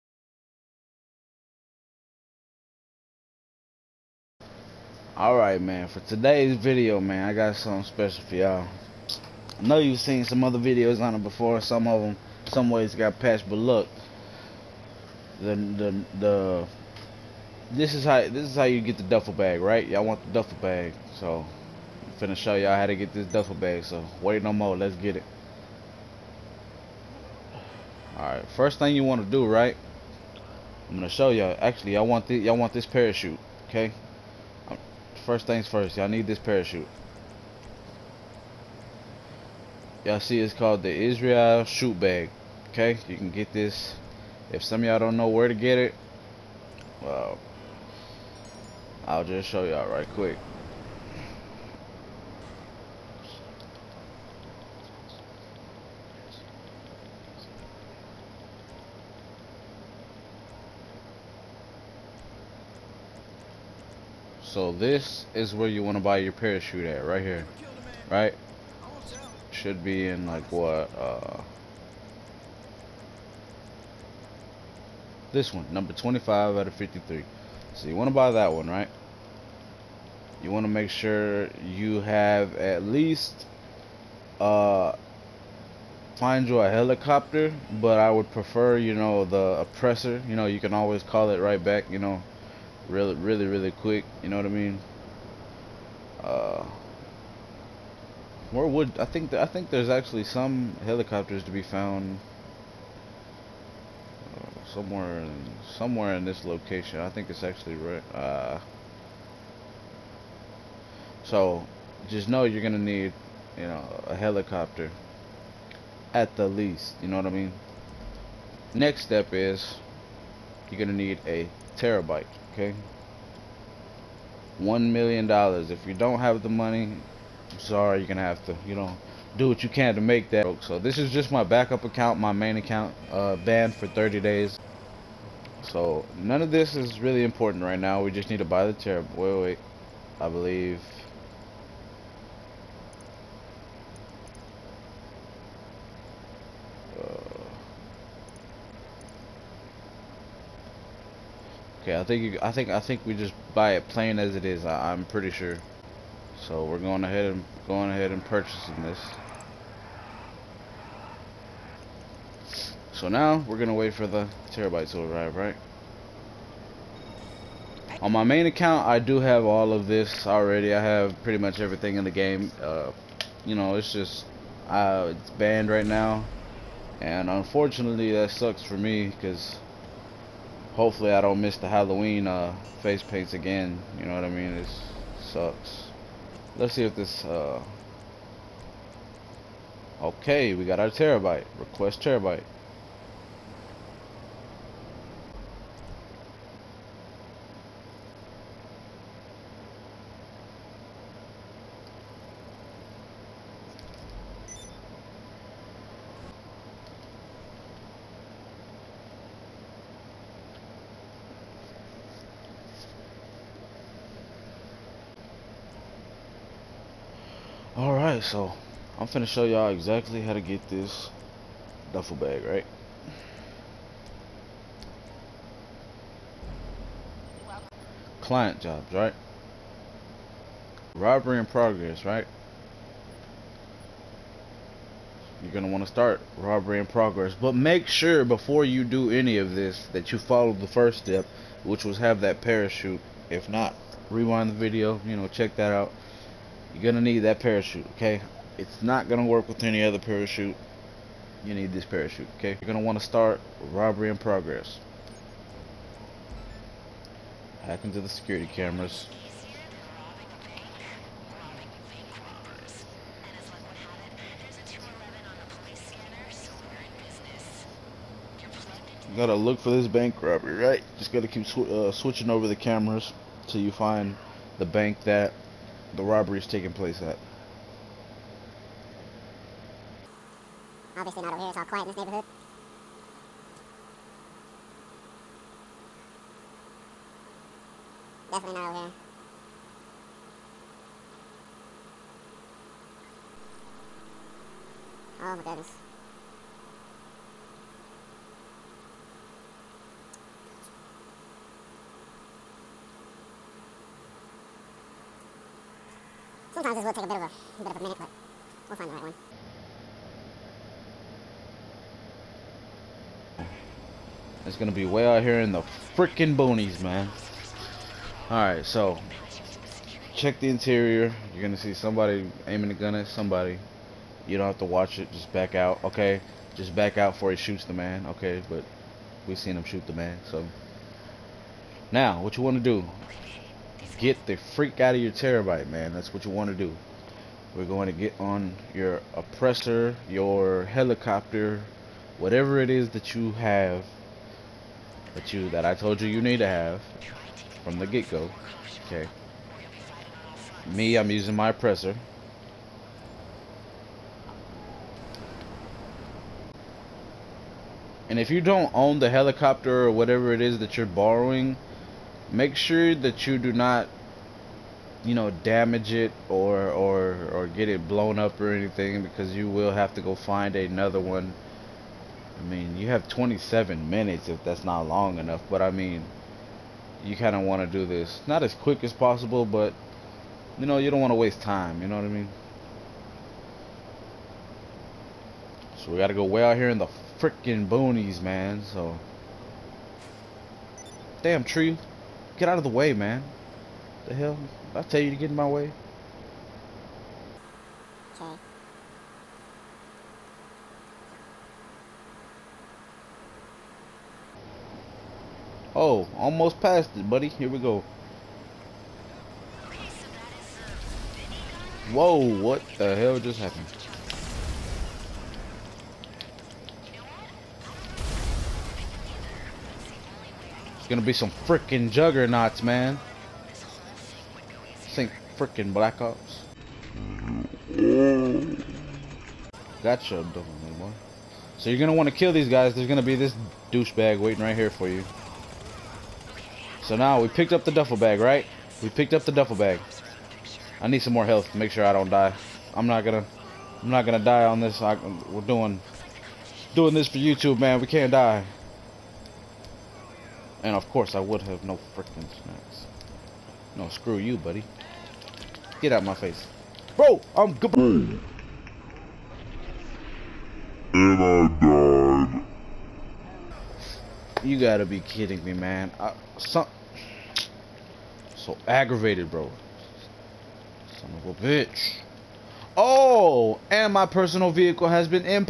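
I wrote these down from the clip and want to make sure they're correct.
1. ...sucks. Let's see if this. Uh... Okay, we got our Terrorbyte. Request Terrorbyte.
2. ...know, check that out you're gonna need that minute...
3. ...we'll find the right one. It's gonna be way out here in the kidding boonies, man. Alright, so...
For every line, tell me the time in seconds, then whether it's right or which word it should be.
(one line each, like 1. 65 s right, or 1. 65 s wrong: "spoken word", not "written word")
1. 185 s right
2. 245 s wrong: "parachute", not "minute"
3. 308 s wrong: "freaking", not "kidding".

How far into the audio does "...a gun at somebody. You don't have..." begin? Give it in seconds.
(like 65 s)
322 s.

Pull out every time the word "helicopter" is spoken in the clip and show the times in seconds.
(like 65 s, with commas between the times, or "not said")
86 s, 100 s, 114 s, 340 s, 359 s.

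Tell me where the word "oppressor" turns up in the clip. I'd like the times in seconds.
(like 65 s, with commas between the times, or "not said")
89 s, 339 s, 351 s.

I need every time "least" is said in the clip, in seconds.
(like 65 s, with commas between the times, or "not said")
82 s, 116 s.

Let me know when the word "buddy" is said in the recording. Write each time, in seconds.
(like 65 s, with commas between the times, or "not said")
407 s, 454 s.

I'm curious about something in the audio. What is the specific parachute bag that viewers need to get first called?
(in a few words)
Israel shoot bag.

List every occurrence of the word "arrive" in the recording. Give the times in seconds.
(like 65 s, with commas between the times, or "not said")
165 s.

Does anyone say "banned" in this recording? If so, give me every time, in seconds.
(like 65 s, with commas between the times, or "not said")
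133 s, 175 s.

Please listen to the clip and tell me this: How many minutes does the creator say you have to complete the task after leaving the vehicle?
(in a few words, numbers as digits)
27.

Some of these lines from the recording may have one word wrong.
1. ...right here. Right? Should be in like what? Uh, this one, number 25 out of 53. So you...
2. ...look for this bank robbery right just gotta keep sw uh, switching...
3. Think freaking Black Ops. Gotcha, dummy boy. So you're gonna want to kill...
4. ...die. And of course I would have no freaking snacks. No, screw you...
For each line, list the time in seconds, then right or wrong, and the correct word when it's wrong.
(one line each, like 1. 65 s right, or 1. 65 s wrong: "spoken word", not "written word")
1. 67 s right
2. 269 s right
3. 424 s right
4. 448 s right.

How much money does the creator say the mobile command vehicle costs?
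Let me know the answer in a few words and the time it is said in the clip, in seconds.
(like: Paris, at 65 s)
$1,000,000, at 124 s.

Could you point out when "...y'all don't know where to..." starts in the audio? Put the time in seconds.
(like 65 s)
44 s.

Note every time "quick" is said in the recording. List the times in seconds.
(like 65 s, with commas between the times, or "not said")
50 s, 93 s, 378 s.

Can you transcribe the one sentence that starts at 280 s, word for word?
Obviously not over here, it's all quiet in this neighborhood.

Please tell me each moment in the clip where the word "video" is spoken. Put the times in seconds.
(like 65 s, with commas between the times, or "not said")
6 s, 10 s, 244 s.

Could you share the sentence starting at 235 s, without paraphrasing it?
You're going to want to start robbery in progress.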